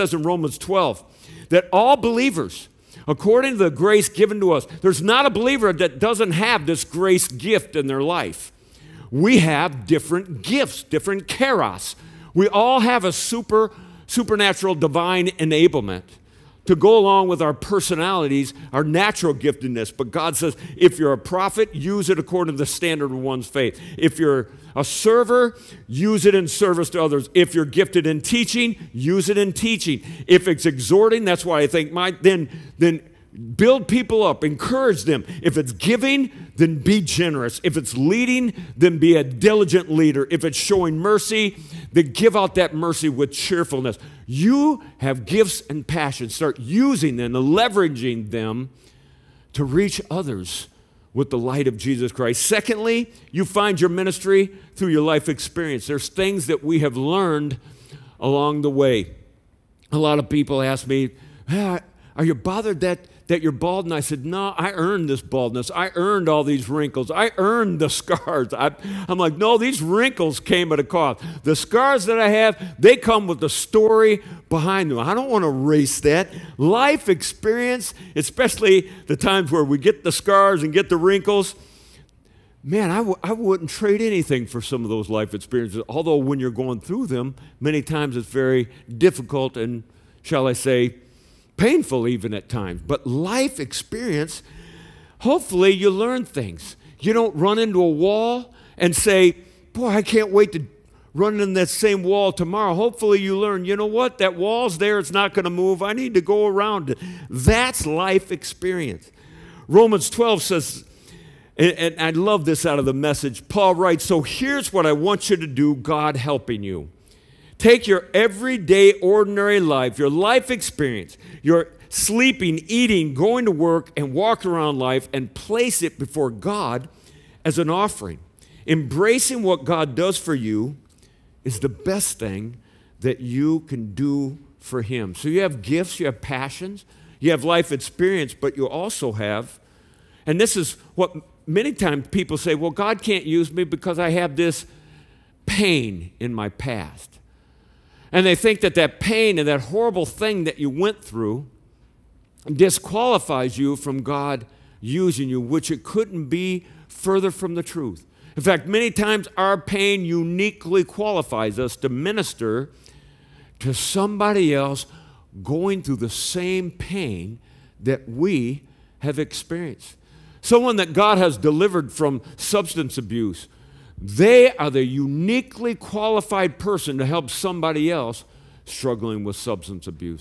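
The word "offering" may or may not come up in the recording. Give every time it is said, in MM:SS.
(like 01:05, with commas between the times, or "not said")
02:07.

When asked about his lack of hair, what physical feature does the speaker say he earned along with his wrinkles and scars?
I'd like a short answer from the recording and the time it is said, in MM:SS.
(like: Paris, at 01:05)
Baldness, at 01:05.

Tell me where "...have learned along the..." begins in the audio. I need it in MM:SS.
00:56.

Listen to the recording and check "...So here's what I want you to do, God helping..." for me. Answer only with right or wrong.
right.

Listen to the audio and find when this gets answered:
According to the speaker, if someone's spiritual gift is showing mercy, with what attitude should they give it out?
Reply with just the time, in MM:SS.
00:43.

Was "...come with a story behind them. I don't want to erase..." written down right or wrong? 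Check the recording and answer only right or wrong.
right.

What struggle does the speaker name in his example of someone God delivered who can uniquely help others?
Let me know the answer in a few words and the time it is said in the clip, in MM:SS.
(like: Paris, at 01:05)
Substance abuse, at 02:52.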